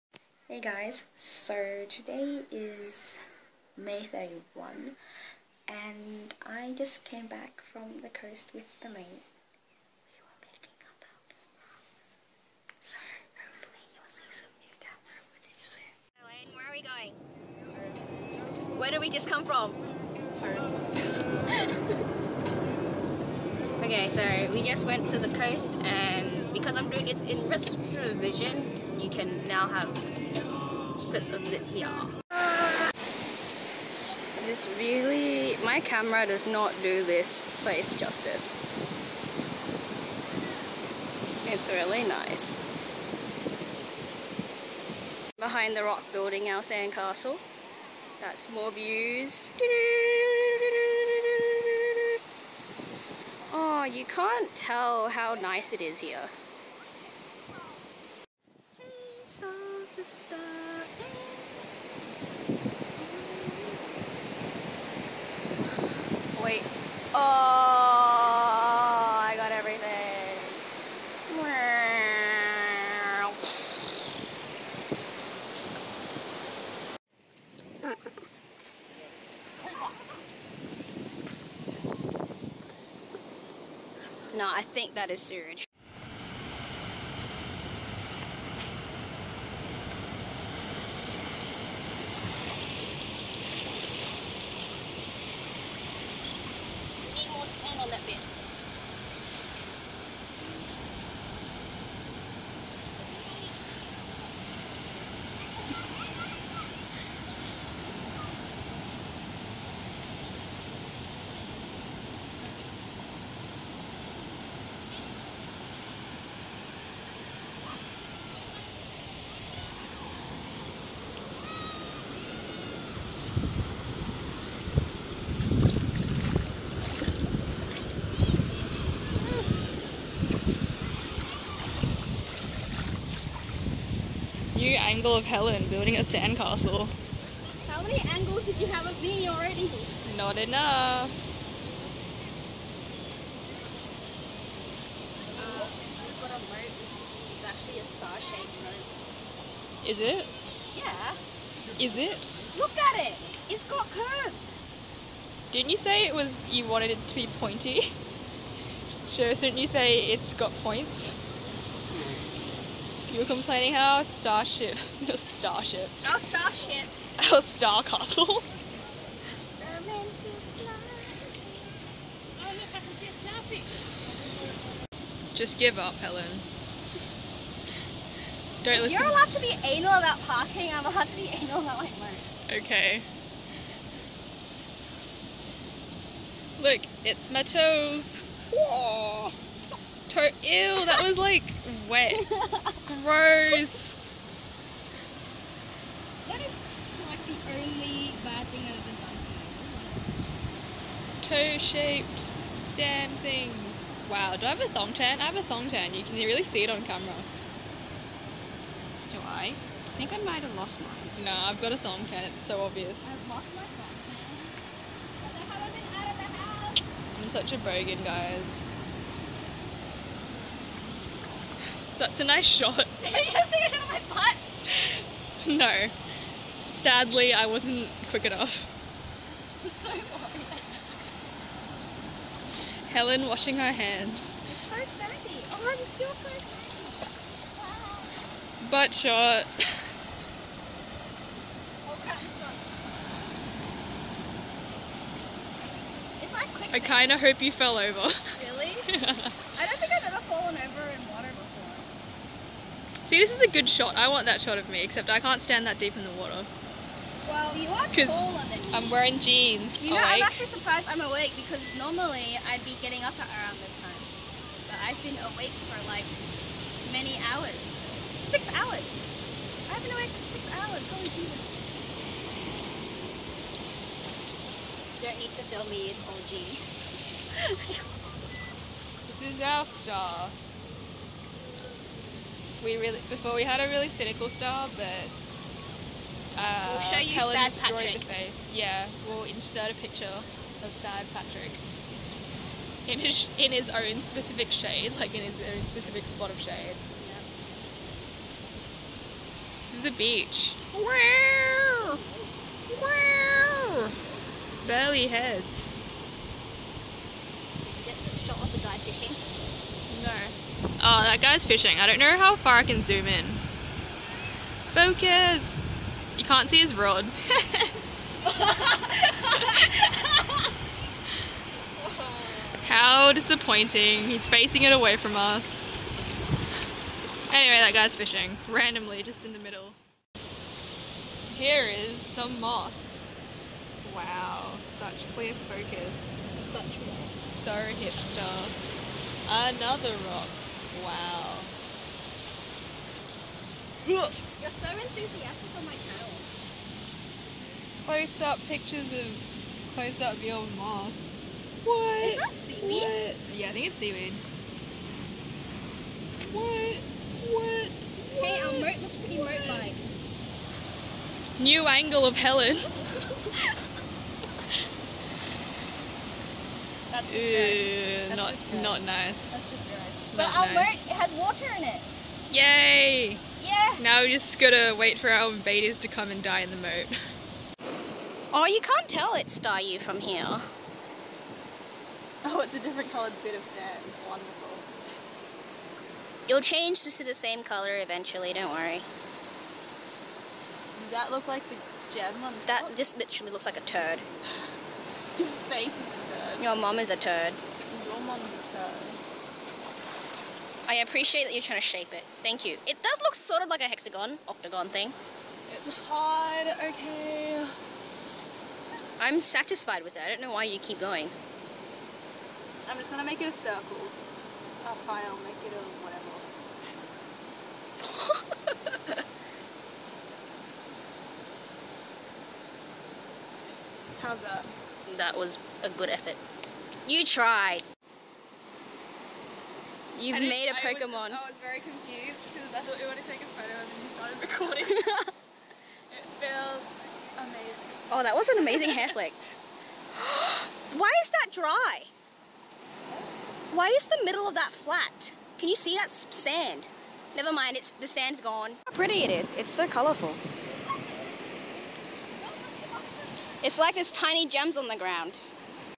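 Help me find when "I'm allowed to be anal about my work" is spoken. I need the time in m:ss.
3:00.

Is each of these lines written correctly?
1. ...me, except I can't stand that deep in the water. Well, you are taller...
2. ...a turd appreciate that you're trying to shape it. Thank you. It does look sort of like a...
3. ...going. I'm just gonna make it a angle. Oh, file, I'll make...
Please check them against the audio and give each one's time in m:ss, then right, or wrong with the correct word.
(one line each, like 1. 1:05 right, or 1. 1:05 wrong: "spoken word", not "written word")
1. 4:14 right
2. 6:38 right
3. 6:50 wrong: "circle", not "angle".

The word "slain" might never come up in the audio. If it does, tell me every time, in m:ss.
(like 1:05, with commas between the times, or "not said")
not said.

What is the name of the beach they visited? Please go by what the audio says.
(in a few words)
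Burleigh Heads.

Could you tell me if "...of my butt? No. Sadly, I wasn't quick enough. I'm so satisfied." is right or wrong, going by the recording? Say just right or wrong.
wrong.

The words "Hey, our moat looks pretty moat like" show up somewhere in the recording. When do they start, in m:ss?
5:58.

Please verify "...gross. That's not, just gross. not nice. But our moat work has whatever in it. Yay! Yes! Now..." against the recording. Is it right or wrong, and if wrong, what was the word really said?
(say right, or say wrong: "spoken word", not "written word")
wrong: "water", not "whatever".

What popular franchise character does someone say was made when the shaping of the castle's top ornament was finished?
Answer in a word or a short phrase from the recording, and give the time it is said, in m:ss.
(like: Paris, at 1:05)
A Pokemon, at 7:10.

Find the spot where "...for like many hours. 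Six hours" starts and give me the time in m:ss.
4:25.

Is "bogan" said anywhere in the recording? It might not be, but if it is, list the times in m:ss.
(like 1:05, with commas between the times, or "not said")
3:37.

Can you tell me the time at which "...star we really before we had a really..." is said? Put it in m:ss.
4:39.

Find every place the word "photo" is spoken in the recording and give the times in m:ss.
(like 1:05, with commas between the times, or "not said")
7:13.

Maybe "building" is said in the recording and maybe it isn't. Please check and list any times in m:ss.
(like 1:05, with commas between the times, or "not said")
0:46, 2:15.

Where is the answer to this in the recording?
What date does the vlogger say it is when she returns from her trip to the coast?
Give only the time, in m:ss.
0:03.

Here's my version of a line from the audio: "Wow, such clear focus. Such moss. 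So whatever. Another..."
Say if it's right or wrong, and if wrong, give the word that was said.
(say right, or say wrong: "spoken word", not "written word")
wrong: "hipster", not "whatever".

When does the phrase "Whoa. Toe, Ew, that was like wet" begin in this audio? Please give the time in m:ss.
3:08.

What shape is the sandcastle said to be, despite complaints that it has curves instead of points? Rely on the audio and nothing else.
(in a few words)
Star-shaped.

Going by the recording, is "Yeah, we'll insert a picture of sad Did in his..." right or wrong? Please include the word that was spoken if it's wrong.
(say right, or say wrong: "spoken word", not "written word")
wrong: "Patrick", not "Did".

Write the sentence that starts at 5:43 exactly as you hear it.
You're so enthusiastic on my channel.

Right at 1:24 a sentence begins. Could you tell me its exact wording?
No, I think that is sewage.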